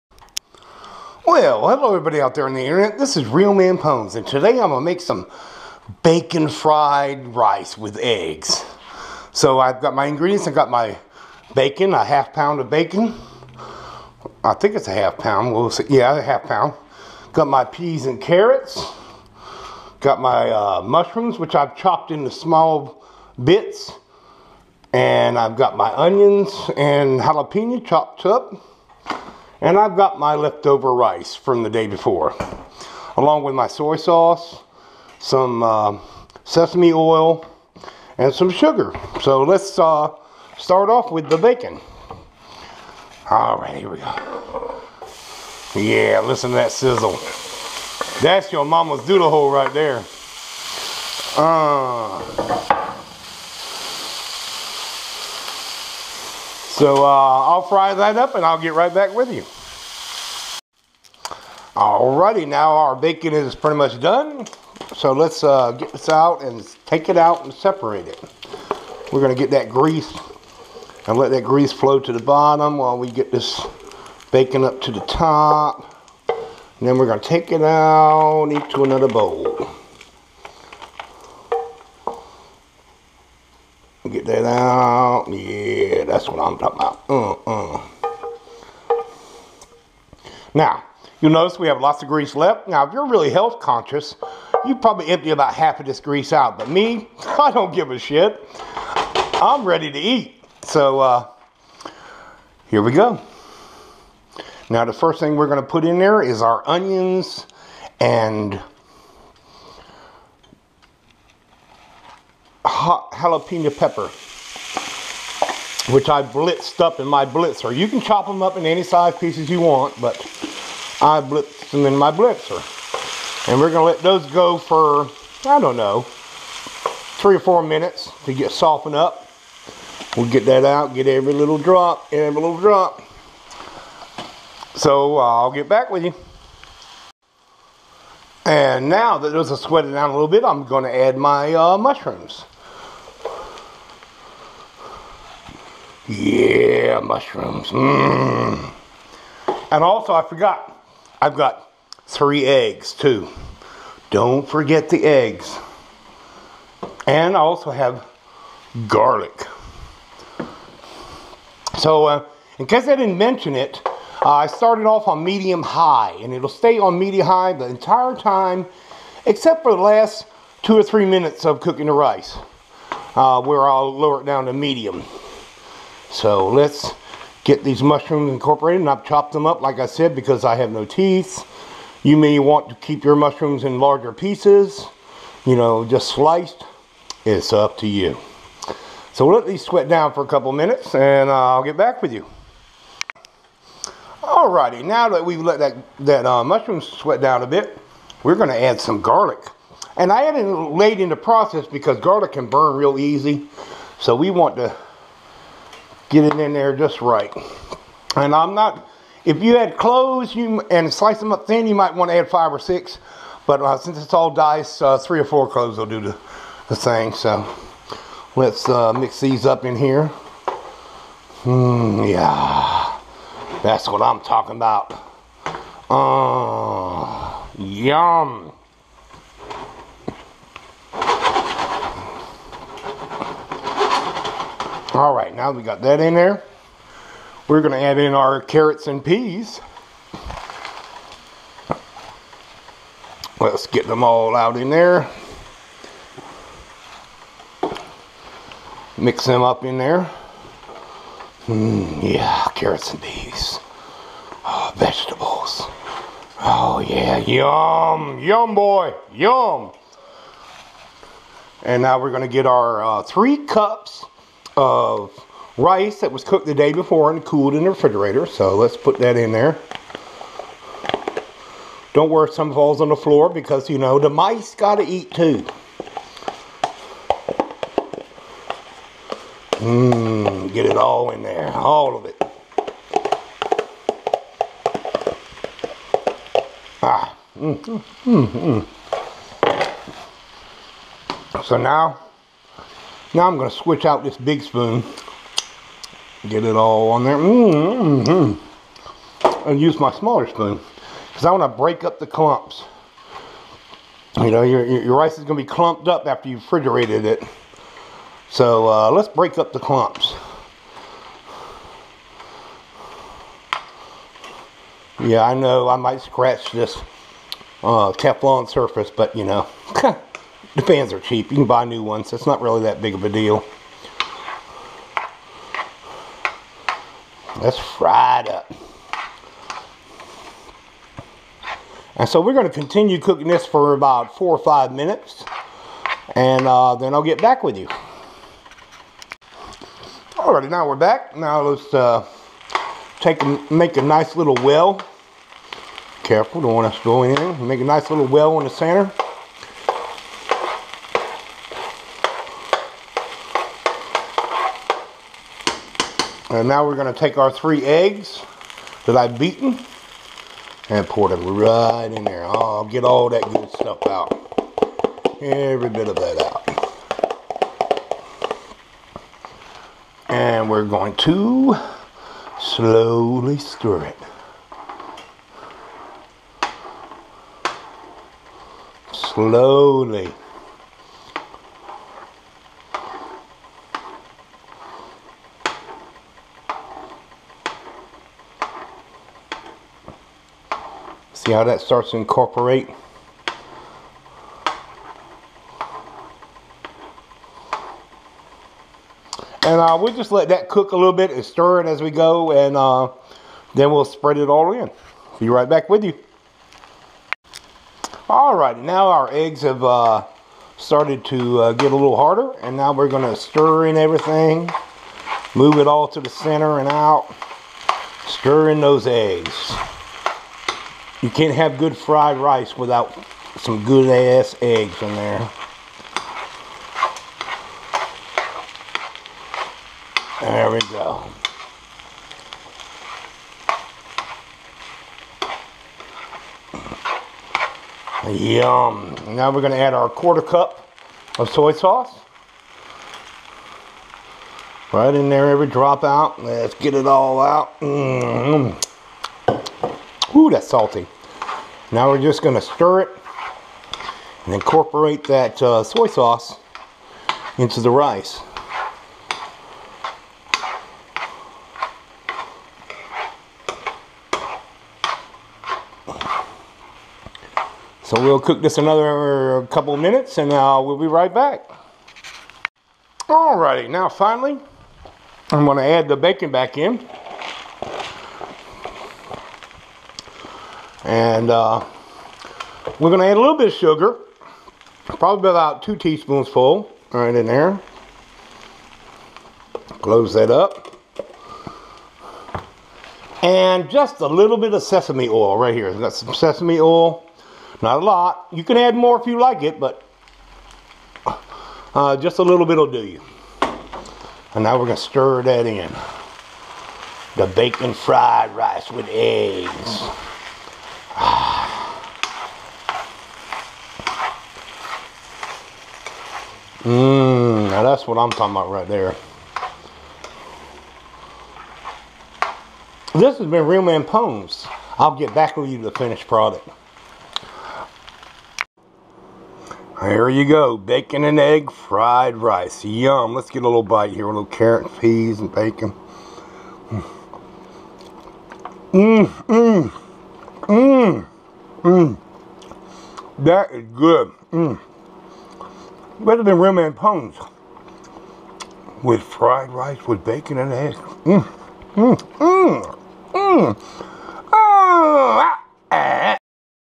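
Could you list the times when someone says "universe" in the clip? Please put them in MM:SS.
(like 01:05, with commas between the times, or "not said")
not said.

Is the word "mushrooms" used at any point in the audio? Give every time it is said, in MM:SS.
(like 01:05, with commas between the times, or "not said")
00:20, 02:21, 02:26, 02:57, 03:03, 03:16.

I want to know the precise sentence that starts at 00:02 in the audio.
This is RealmanPwns, and today I'm gonna make some bacon fried rice with eggs.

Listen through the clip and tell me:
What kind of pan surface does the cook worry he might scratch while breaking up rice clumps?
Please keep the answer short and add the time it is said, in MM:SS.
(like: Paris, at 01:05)
Teflon, at 05:17.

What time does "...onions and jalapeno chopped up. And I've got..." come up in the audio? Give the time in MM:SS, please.
00:25.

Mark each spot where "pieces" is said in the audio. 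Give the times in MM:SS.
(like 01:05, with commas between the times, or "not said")
01:59, 03:04.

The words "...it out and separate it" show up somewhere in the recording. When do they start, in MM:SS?
01:07.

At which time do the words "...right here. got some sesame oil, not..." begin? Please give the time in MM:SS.
08:15.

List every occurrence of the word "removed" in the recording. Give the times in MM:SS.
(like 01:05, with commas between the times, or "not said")
not said.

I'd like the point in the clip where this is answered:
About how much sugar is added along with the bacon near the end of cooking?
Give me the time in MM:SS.
08:05.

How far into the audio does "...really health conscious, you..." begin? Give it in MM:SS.
01:33.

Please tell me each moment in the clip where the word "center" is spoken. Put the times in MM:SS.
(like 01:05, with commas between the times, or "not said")
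05:48, 06:56.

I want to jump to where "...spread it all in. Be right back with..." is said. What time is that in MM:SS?
06:43.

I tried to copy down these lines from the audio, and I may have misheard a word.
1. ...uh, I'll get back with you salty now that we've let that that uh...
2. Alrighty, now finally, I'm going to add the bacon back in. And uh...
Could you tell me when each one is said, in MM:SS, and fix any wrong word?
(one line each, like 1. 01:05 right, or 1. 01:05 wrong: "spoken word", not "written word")
1. 03:11 wrong: "alrighty", not "salty"
2. 07:53 right.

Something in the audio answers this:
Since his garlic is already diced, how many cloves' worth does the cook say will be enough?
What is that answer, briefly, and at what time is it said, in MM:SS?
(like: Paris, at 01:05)
3 or 4, at 03:34.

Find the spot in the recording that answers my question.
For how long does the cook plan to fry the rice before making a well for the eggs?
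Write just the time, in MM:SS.
05:34.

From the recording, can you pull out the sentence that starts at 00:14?
I think it's a half pound.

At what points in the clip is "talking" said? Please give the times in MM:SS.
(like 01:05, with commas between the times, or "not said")
01:26, 03:44, 08:38.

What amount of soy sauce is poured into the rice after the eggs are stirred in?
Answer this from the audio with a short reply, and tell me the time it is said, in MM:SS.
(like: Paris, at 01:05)
quarter cup, at 07:19.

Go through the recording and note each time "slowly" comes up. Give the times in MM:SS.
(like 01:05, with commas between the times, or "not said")
06:12, 06:18.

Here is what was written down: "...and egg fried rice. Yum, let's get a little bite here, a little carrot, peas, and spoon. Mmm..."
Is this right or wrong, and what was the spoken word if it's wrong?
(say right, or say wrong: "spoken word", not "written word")
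wrong: "bacon", not "spoon".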